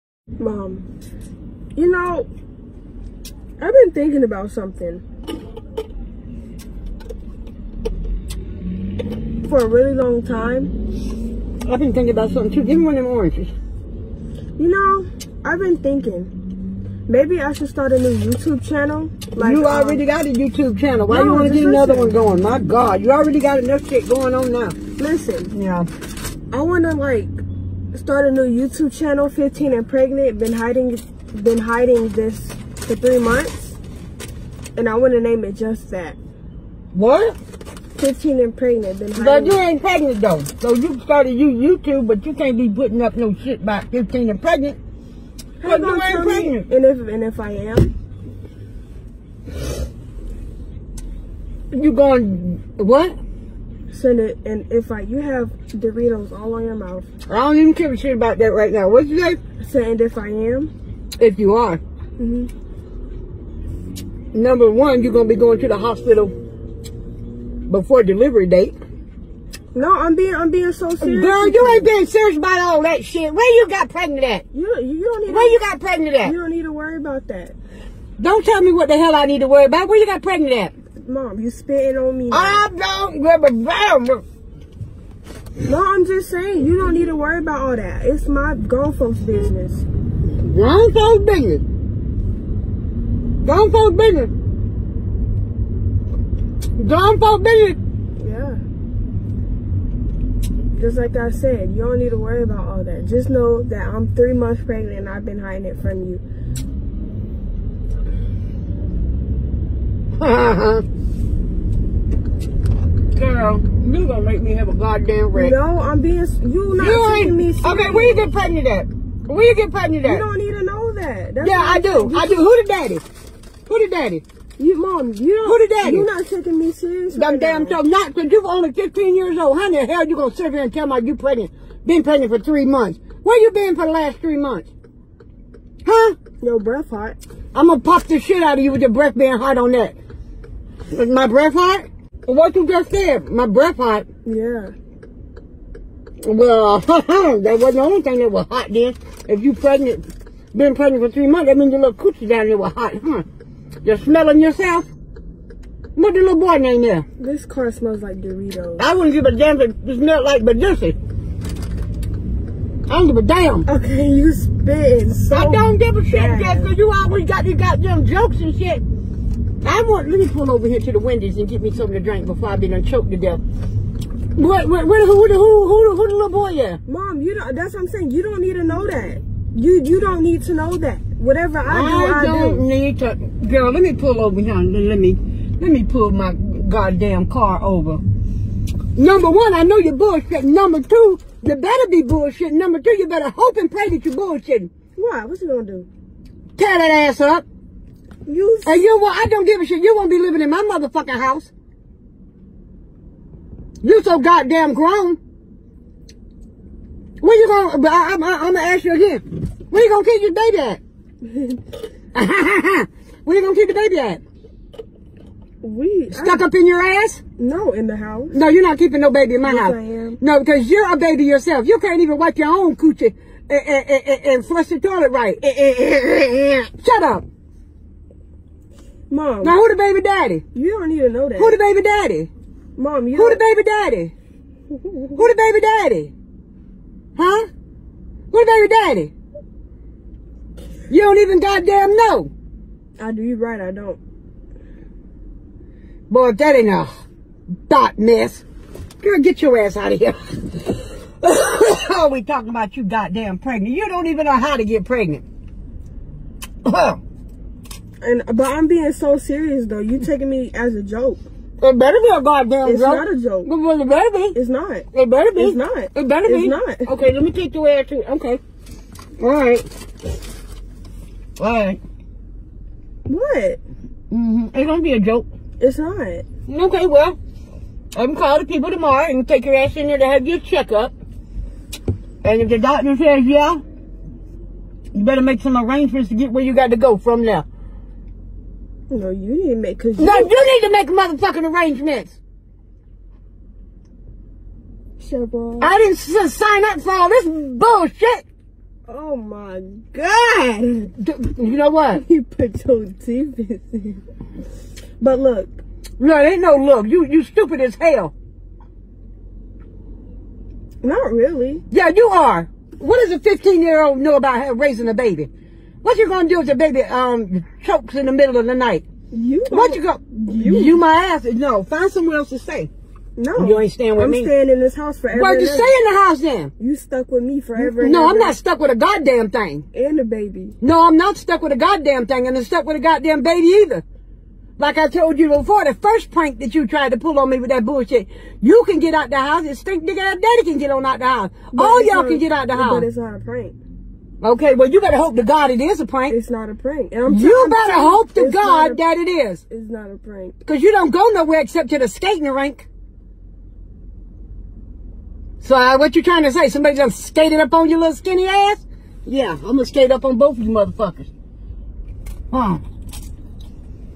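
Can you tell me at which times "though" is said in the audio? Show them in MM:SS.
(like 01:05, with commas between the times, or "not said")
00:40, 04:19.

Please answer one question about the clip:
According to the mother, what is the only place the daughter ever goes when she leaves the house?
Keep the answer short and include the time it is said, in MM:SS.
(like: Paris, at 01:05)
skating rink, at 05:51.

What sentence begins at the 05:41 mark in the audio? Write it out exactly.
But All y'all can get out the house.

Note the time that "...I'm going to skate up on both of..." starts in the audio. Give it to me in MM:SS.
05:59.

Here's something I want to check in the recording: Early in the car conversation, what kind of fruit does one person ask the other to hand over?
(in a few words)
oranges.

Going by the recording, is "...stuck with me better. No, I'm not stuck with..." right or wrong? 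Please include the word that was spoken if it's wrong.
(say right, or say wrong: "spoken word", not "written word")
wrong: "forever", not "better".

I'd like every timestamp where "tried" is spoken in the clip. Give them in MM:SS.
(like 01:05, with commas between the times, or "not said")
05:36.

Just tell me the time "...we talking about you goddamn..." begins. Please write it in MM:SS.
04:12.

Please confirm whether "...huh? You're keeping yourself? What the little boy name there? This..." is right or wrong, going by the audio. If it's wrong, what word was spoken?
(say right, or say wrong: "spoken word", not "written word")
wrong: "smelling", not "keeping".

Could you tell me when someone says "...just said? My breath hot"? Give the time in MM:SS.
02:22.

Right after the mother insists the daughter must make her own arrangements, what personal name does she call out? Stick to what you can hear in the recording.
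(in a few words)
Cheryl.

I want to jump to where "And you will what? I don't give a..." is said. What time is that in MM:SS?
03:18.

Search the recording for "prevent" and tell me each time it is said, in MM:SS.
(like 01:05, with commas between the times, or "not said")
not said.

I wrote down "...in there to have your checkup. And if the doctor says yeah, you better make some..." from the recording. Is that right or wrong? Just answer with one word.
right.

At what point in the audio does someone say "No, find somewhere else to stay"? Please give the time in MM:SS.
05:21.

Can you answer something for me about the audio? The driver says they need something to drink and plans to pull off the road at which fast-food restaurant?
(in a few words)
Wendy's.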